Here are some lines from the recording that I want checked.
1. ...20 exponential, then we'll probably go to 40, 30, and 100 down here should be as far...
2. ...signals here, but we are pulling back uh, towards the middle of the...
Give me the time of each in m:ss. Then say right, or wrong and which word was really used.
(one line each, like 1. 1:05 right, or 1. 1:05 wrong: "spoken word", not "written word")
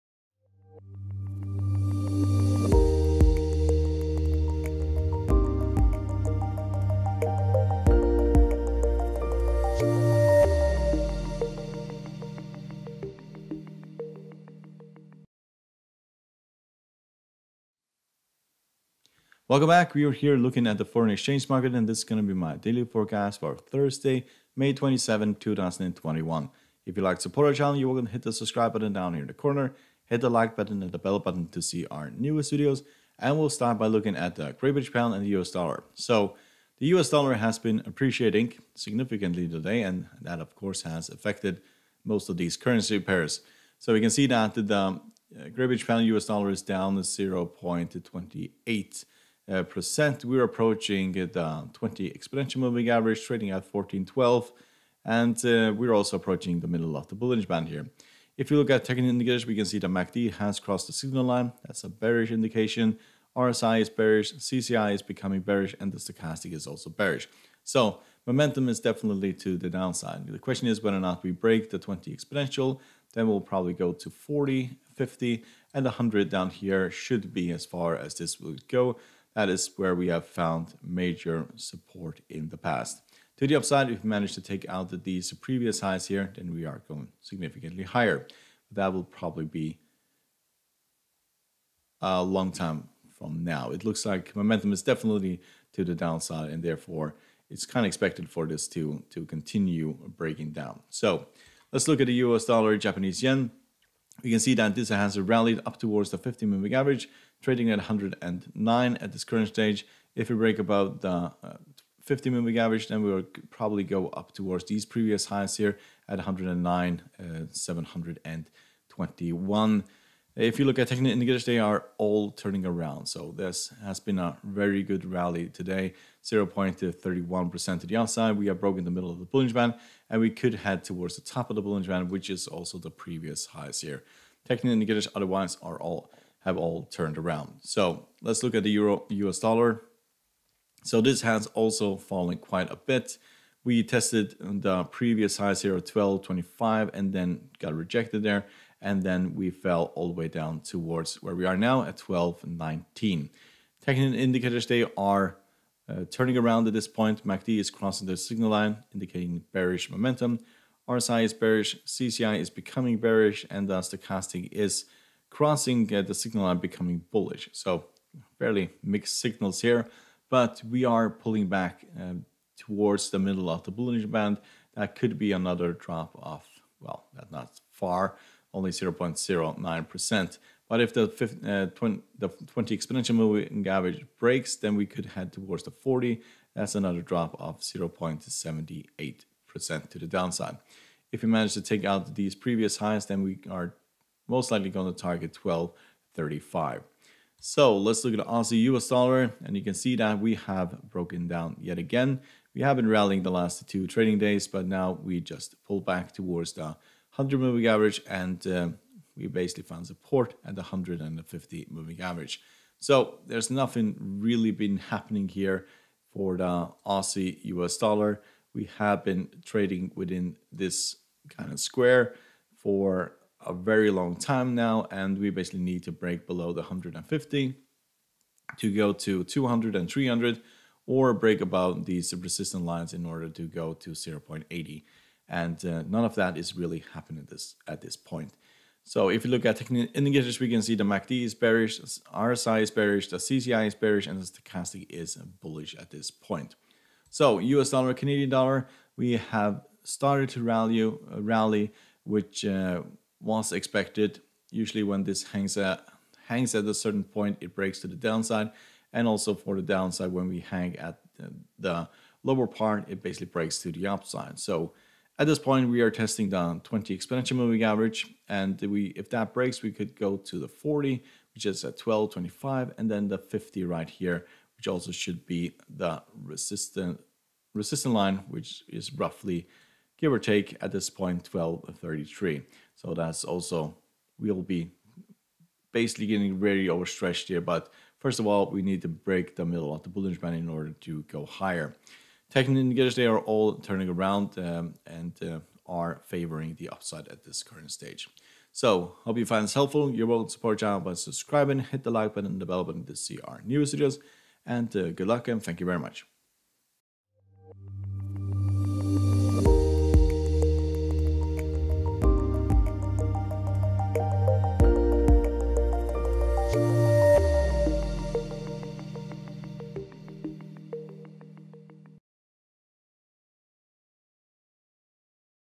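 1. 1:11 wrong: "50", not "30"
2. 2:49 right.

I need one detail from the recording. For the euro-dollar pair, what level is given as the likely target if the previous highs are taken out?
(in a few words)
1.235.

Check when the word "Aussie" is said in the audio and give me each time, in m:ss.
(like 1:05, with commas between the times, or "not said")
3:18, 3:36.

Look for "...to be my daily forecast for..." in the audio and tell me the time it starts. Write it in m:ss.
0:22.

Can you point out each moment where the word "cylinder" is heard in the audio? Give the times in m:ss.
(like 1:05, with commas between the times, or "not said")
not said.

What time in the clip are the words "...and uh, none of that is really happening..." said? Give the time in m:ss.
3:55.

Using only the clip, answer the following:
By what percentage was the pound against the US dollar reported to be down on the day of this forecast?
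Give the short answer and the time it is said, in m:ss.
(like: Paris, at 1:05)
0.28%, at 0:46.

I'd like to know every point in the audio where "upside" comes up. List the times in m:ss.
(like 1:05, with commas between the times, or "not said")
1:23, 2:07, 4:23, 4:56.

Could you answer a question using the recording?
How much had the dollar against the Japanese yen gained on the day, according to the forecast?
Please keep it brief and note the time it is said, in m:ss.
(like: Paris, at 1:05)
0.31%, at 2:06.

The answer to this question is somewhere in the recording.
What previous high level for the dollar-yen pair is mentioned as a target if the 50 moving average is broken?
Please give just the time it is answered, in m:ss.
1:56.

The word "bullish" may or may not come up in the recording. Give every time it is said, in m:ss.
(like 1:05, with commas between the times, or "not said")
2:47, 4:05.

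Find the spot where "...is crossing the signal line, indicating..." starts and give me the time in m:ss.
2:37.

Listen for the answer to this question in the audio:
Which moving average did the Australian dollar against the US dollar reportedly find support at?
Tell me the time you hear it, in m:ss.
3:30.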